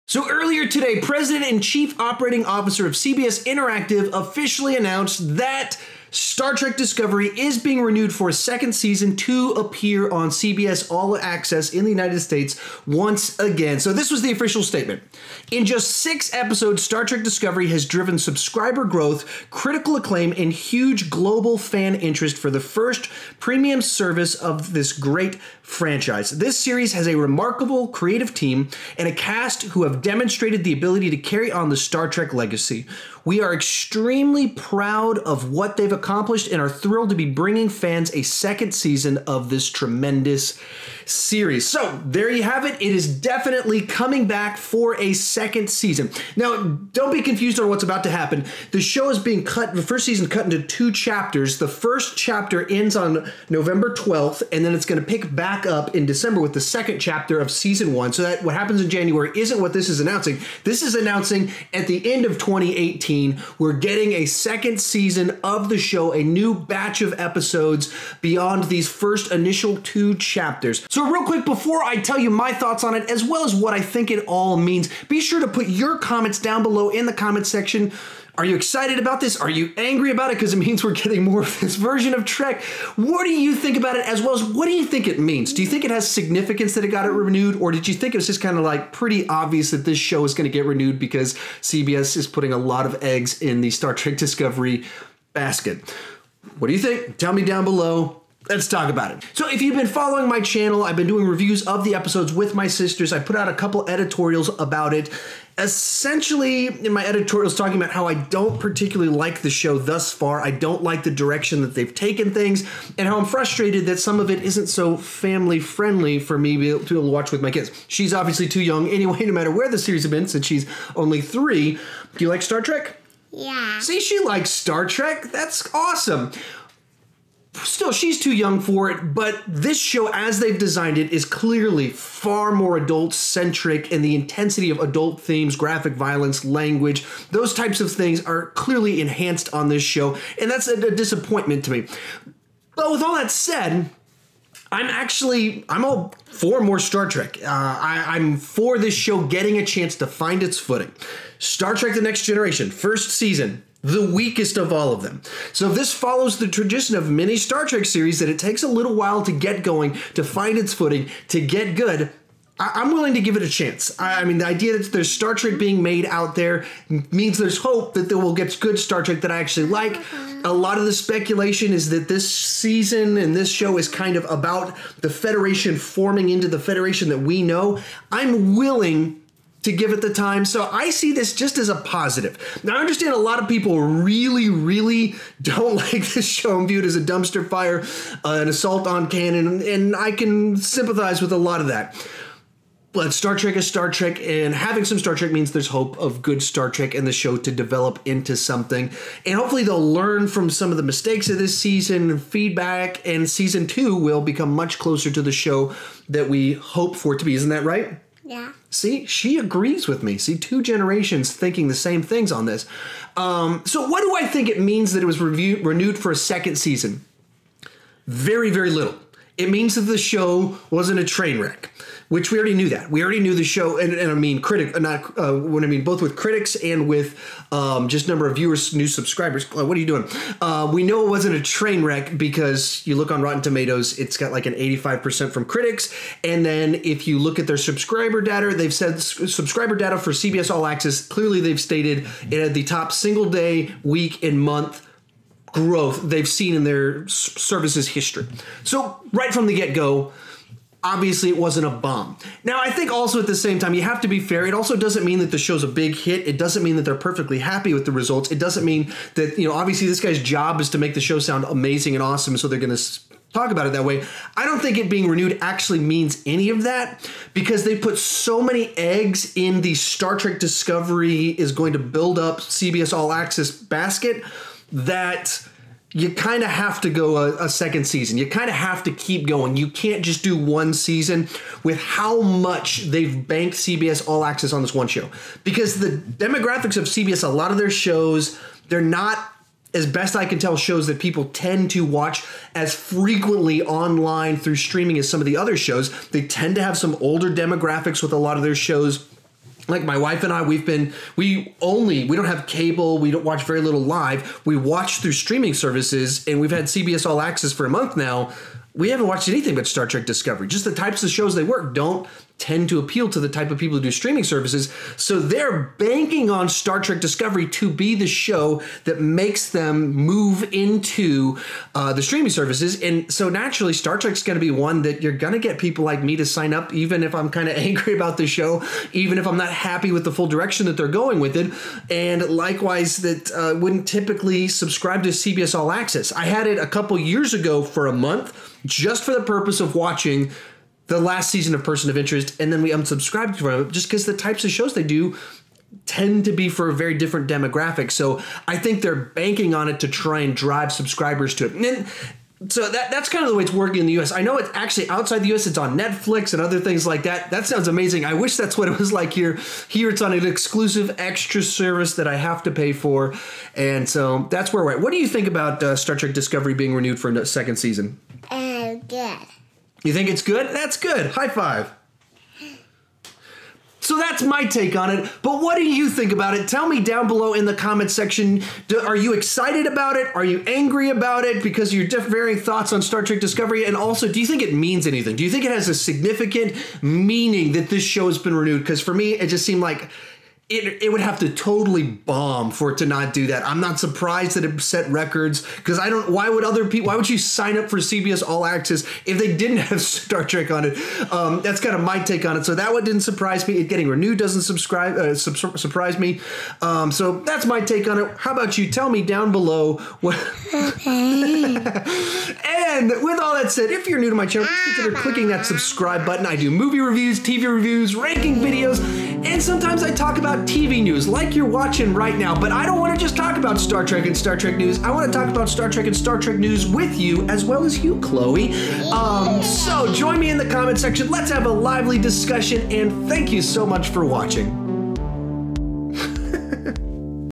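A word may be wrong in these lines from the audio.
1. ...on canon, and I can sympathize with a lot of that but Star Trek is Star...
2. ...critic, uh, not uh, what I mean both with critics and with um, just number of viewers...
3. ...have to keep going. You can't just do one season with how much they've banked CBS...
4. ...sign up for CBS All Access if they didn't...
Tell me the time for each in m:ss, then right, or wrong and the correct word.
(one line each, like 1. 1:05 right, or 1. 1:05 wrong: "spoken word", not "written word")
1. 3:08 right
2. 3:44 right
3. 4:38 right
4. 6:37 right.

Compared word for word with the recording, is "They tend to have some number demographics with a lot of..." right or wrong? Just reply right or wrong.
wrong.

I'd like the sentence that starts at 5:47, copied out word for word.
So I think they're banking on it to try and drive subscribers to it.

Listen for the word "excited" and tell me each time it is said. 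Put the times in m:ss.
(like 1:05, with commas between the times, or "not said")
1:18, 6:19.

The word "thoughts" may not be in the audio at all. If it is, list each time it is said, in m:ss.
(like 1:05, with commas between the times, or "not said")
1:12, 6:22.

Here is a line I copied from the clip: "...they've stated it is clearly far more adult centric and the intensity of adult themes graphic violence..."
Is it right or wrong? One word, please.
wrong.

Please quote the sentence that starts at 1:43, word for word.
I put out a couple editorials about it.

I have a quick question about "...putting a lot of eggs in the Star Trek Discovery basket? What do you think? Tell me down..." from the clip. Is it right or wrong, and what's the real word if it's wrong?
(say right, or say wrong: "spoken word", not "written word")
right.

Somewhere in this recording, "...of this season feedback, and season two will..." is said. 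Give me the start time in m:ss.
3:21.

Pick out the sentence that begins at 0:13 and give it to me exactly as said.
So, this was the official statement.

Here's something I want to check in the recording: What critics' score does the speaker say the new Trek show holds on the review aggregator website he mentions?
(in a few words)
85%.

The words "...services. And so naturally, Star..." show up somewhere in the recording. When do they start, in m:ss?
5:22.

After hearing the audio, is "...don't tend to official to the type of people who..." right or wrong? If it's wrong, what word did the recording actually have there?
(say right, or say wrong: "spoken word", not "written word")
wrong: "appeal", not "official".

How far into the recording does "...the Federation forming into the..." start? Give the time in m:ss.
2:55.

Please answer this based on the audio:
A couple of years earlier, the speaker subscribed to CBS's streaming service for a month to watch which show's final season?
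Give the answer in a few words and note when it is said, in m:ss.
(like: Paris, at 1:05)
Person of Interest, at 5:41.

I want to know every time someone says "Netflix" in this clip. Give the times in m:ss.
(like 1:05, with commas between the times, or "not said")
5:55.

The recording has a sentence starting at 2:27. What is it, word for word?
Uh, I, am for this show getting a chance to find its footing.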